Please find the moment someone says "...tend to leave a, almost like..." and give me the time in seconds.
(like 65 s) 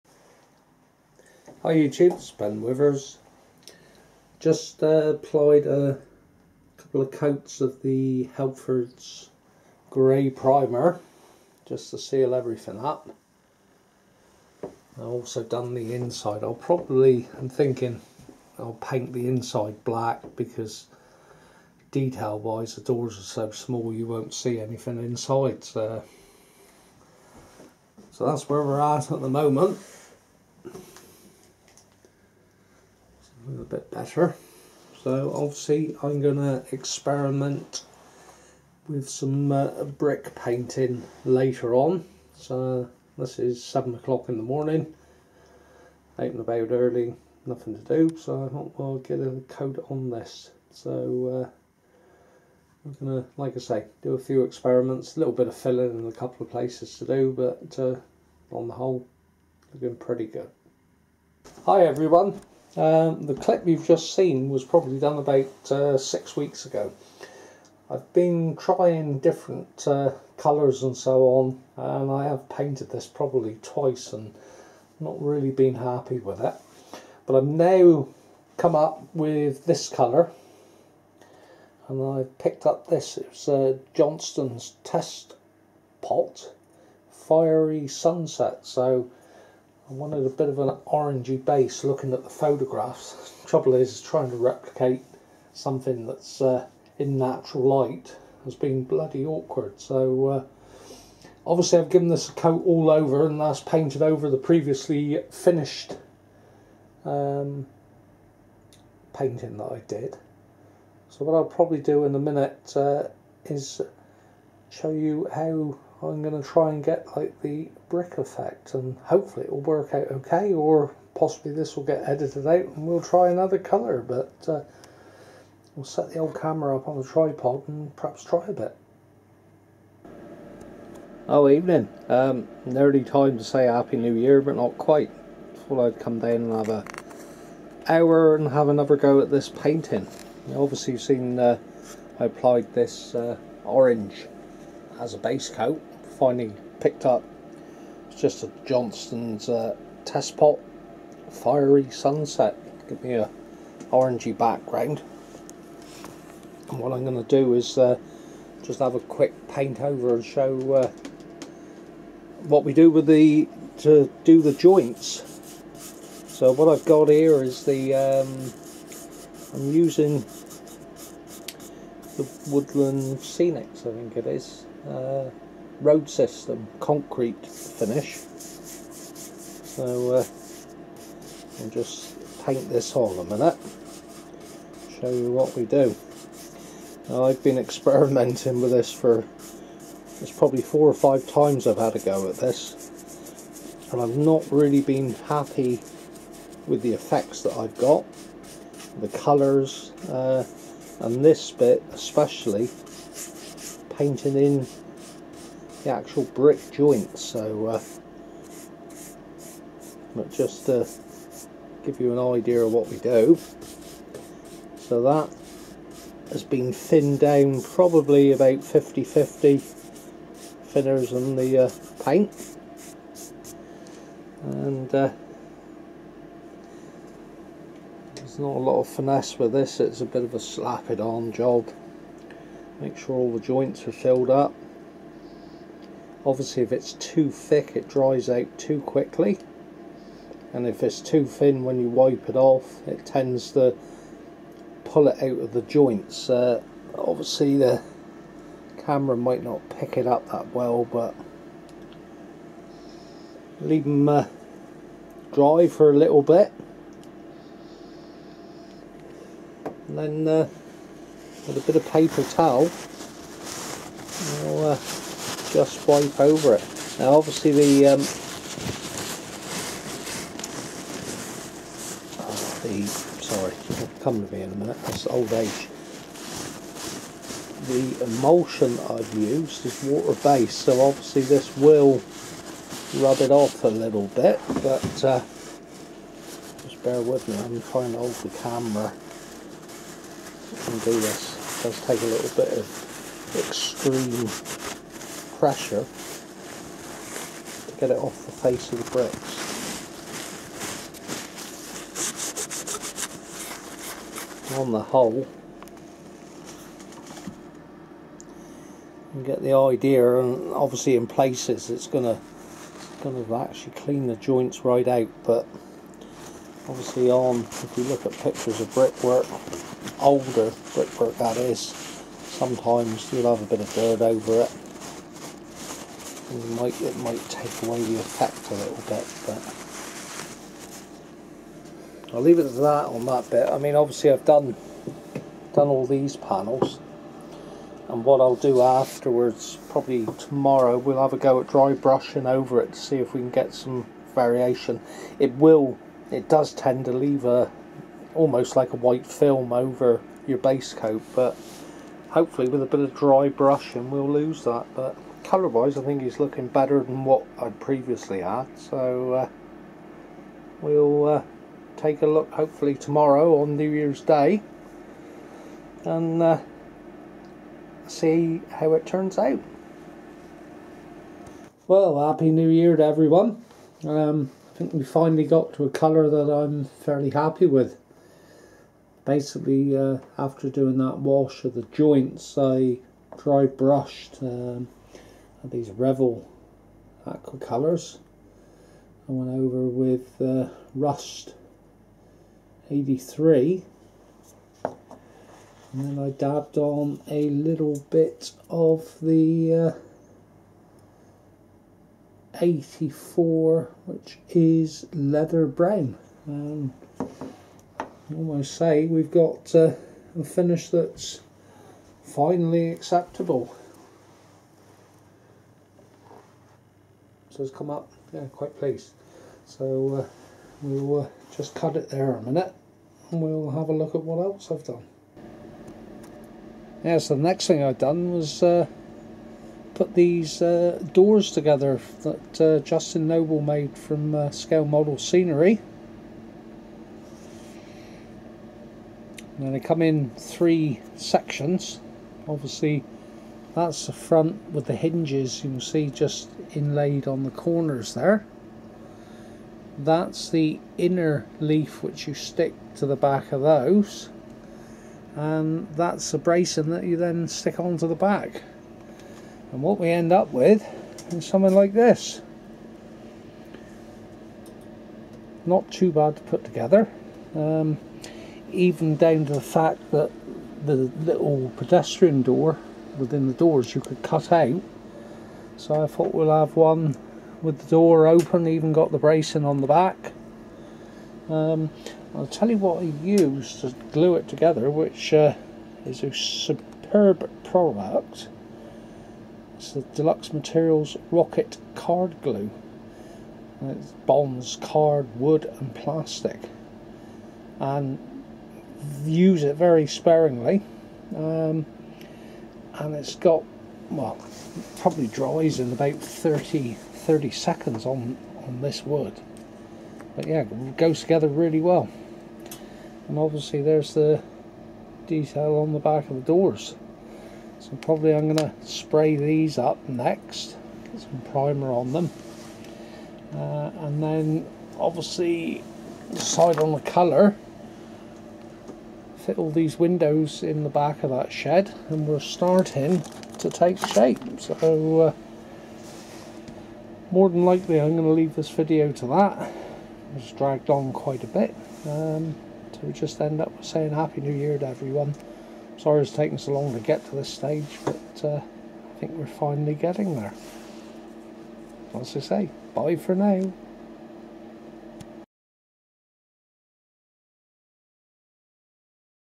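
346 s.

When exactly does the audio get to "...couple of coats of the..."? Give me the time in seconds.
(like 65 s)
6 s.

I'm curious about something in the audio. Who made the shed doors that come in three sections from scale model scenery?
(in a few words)
Justin Noble.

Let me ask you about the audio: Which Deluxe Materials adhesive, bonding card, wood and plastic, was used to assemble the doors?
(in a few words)
Rocket Card Glue.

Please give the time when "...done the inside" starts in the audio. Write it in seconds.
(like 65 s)
15 s.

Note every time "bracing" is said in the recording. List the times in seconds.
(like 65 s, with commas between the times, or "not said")
456 s, 478 s.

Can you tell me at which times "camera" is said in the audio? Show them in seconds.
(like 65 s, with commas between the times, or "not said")
126 s, 248 s, 288 s.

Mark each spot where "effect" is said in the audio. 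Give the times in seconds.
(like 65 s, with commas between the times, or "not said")
118 s, 196 s, 327 s.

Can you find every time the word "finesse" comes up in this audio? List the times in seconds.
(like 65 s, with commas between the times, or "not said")
228 s.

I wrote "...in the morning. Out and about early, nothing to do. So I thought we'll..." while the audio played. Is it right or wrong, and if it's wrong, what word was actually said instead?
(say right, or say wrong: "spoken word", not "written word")
right.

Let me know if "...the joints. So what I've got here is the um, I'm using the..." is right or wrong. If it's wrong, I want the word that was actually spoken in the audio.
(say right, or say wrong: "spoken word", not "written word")
right.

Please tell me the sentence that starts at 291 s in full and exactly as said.
It does take a little bit of extreme pressure to get it off the face of the bricks.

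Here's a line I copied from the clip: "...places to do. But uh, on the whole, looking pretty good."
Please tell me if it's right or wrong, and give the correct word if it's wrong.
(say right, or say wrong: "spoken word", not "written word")
right.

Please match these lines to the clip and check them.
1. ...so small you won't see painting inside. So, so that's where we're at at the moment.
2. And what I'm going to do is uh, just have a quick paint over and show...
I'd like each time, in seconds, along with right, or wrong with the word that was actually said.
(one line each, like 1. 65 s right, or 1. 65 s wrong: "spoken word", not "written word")
1. 23 s wrong: "anything", not "painting"
2. 156 s right.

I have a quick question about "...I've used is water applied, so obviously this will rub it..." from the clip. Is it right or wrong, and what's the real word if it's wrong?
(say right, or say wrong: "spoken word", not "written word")
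wrong: "based", not "applied".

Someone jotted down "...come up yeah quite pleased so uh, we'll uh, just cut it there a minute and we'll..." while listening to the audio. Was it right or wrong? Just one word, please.
right.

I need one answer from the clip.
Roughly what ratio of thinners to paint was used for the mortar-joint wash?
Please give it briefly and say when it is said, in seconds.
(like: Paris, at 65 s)
50-50, at 218 s.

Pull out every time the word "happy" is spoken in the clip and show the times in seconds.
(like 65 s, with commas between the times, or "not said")
75 s, 133 s, 195 s, 372 s, 377 s, 543 s.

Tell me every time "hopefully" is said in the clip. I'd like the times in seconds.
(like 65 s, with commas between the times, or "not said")
119 s, 352 s, 362 s.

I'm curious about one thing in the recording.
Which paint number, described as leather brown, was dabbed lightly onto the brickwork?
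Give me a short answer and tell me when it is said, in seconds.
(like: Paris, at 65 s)
84, at 402 s.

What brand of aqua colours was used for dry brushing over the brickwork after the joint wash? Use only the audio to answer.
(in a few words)
Revell.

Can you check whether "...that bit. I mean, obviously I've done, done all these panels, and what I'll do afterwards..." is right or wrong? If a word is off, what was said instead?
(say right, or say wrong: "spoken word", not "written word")
right.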